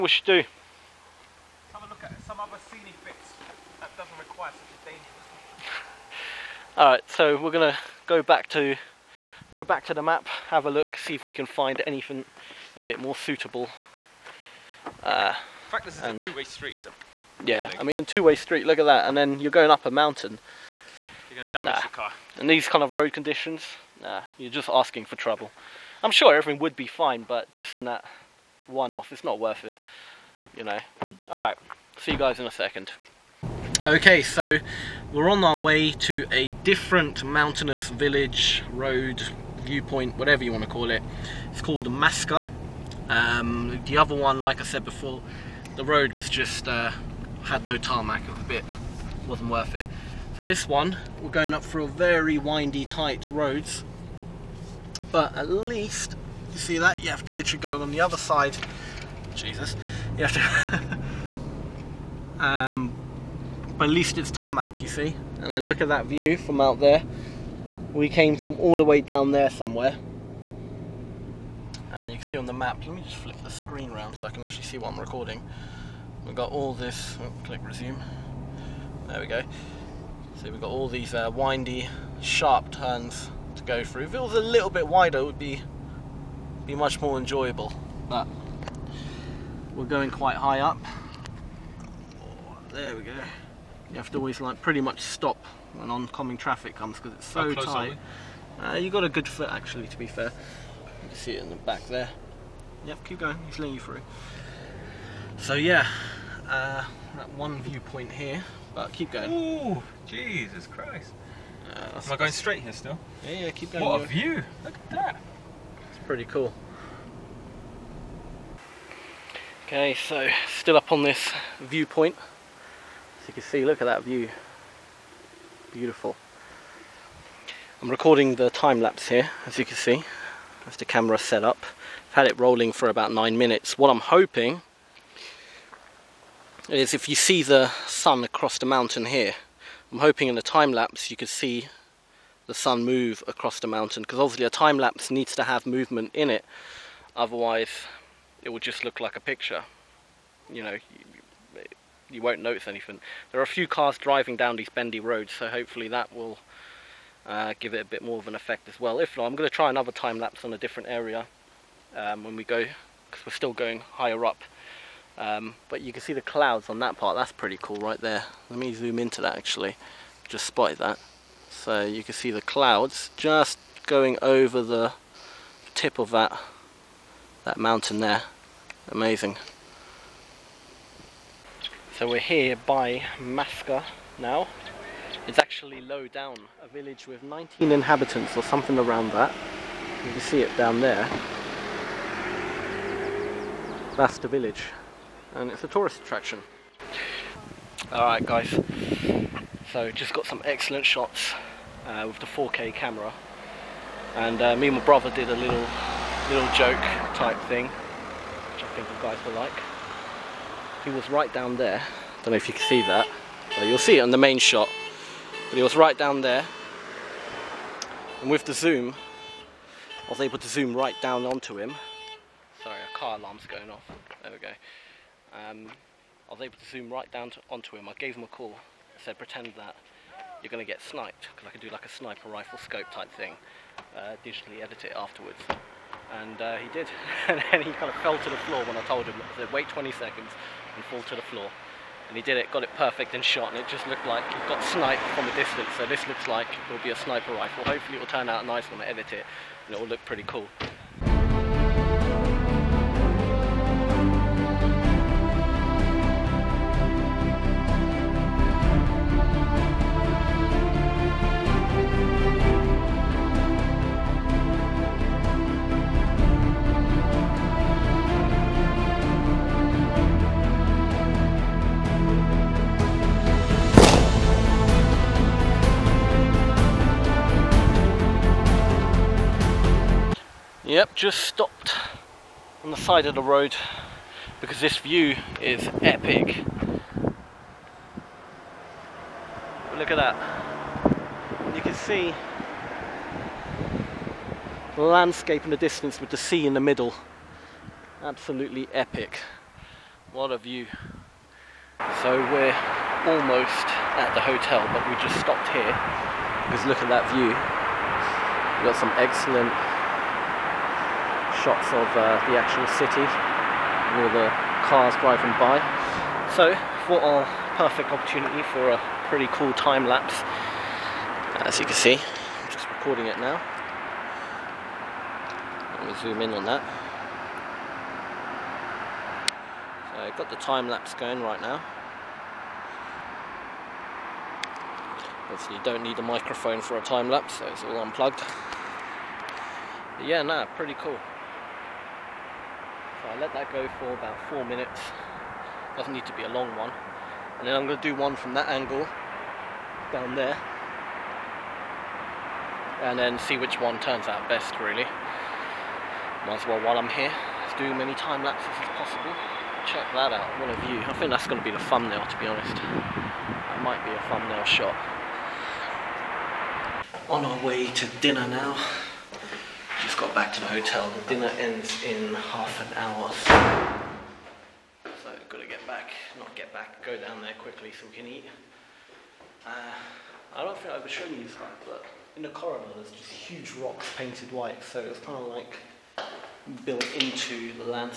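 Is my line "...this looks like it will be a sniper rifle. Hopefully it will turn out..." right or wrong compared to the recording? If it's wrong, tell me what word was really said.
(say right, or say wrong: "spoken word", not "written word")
right.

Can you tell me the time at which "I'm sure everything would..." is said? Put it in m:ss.
0:26.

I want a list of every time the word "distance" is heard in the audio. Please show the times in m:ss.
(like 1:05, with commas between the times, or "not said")
4:05, 4:55.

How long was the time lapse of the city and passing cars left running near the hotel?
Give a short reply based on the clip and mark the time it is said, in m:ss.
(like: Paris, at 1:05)
About 4 minutes, at 5:43.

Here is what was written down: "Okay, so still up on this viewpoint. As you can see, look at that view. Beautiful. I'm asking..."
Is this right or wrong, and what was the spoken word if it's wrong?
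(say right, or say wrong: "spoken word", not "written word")
wrong: "recording", not "asking".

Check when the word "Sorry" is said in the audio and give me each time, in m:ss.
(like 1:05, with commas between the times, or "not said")
3:42.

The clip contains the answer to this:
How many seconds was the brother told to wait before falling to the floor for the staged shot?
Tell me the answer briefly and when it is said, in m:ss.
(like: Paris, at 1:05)
20, at 3:59.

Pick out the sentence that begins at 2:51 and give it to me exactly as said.
So you can see the clouds just going over the tip of that that mountain there.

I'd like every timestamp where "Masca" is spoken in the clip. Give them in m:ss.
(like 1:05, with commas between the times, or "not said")
0:41, 3:03.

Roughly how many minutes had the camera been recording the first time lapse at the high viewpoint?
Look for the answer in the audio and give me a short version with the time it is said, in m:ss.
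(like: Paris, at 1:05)
9, at 2:13.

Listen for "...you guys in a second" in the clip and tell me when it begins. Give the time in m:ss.
0:32.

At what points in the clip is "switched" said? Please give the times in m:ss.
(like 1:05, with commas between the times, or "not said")
not said.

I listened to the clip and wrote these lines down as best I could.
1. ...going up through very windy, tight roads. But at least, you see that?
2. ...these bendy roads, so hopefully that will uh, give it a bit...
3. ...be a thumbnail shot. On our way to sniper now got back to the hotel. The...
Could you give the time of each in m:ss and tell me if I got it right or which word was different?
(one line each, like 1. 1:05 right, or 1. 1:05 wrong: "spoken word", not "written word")
1. 0:51 right
2. 2:34 right
3. 6:03 wrong: "dinner", not "sniper".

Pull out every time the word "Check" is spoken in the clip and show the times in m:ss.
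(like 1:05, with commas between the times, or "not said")
5:59.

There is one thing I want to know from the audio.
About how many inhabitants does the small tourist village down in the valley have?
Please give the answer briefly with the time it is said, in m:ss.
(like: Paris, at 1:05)
19, at 3:07.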